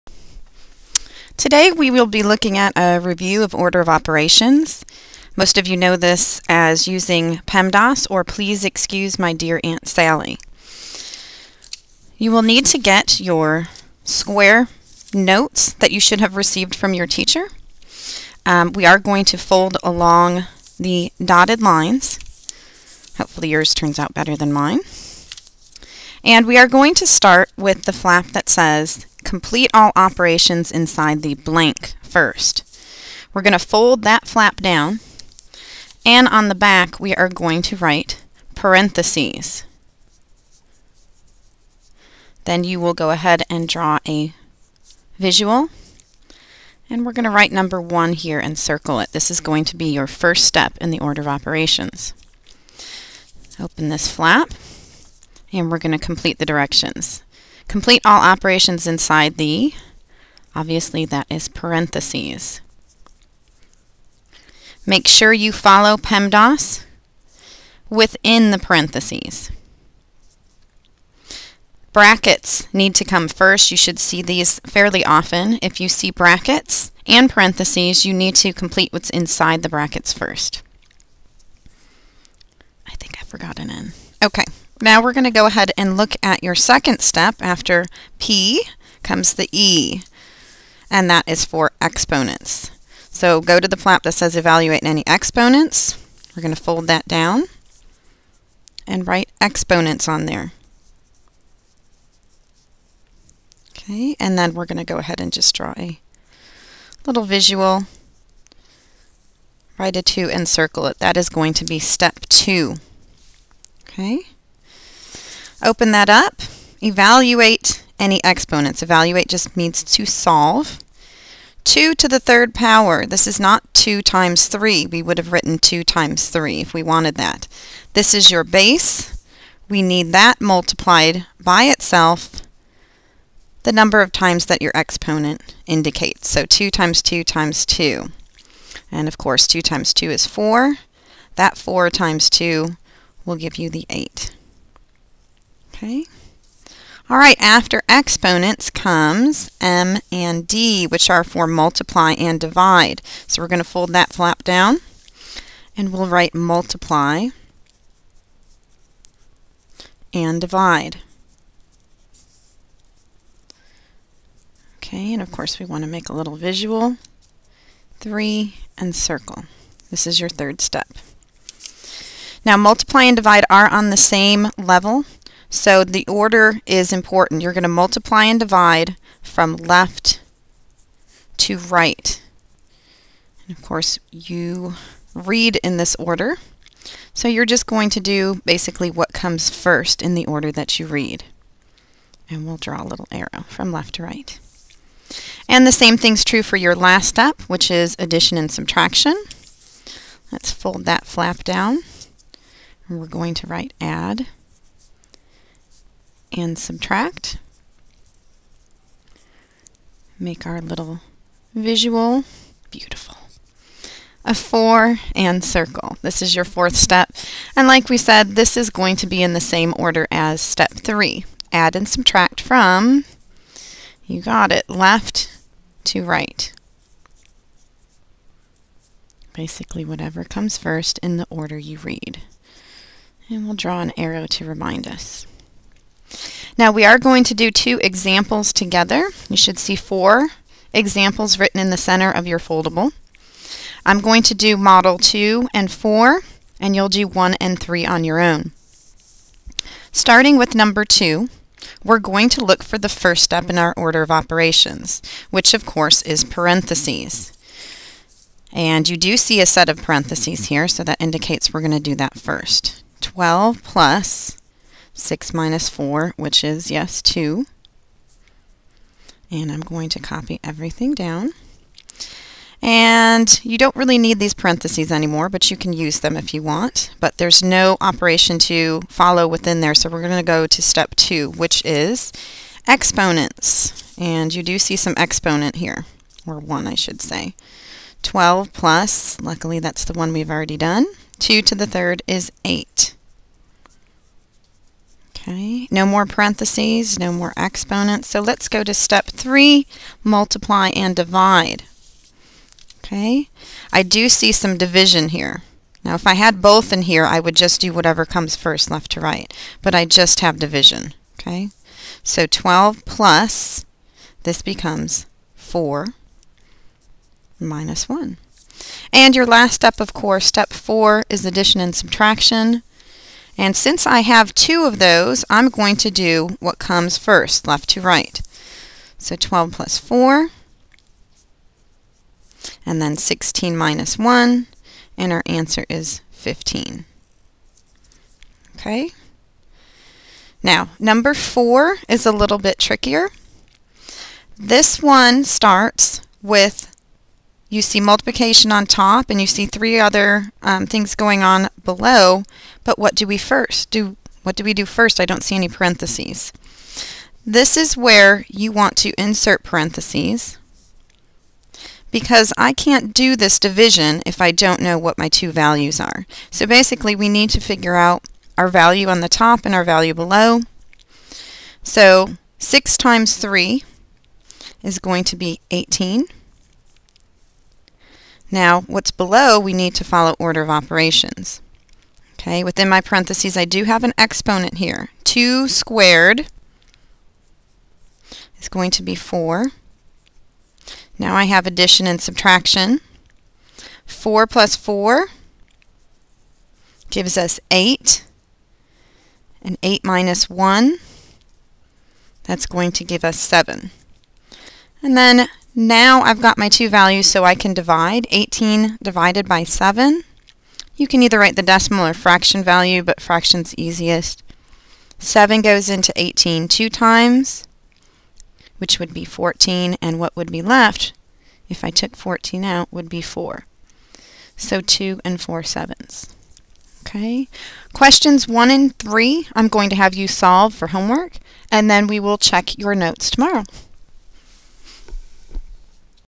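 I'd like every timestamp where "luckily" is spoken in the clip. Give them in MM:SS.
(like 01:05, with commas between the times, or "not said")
04:49.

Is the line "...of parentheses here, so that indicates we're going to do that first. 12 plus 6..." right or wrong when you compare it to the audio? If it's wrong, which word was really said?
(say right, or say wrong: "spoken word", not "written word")
right.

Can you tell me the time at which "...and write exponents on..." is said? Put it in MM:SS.
01:38.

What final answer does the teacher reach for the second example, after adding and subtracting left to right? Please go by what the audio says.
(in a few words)
15.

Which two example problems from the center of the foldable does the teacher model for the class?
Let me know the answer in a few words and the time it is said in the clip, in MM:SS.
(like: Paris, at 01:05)
2 and 4, at 04:04.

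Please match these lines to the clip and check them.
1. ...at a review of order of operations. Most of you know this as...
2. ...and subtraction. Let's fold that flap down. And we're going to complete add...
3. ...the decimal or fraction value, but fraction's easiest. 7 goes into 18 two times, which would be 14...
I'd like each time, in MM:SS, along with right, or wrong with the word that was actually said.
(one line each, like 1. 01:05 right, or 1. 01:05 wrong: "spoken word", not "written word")
1. 00:02 right
2. 03:18 wrong: "write", not "complete"
3. 06:51 right.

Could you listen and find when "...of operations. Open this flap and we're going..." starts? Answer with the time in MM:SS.
00:51.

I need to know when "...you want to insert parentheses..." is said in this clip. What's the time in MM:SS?
05:58.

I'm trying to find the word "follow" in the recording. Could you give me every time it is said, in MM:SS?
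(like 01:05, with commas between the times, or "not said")
01:05, 04:38, 06:19.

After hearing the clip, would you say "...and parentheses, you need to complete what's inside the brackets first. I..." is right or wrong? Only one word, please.
right.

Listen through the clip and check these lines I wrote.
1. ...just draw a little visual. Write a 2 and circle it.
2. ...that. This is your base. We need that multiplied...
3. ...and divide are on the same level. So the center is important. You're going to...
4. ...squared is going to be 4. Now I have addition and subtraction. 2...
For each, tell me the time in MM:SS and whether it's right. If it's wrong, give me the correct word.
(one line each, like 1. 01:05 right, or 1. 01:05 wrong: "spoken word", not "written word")
1. 01:45 right
2. 02:07 right
3. 02:53 wrong: "order", not "center"
4. 06:25 wrong: "4", not "2".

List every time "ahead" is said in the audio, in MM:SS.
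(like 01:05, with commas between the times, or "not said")
00:43, 01:25, 01:44.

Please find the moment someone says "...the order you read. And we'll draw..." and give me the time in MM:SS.
03:51.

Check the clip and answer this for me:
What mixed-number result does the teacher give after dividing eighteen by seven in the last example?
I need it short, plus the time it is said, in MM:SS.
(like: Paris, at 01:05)
2 and 4 sevenths, at 07:04.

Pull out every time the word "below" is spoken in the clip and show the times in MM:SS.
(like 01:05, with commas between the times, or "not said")
05:51, 06:09, 06:18.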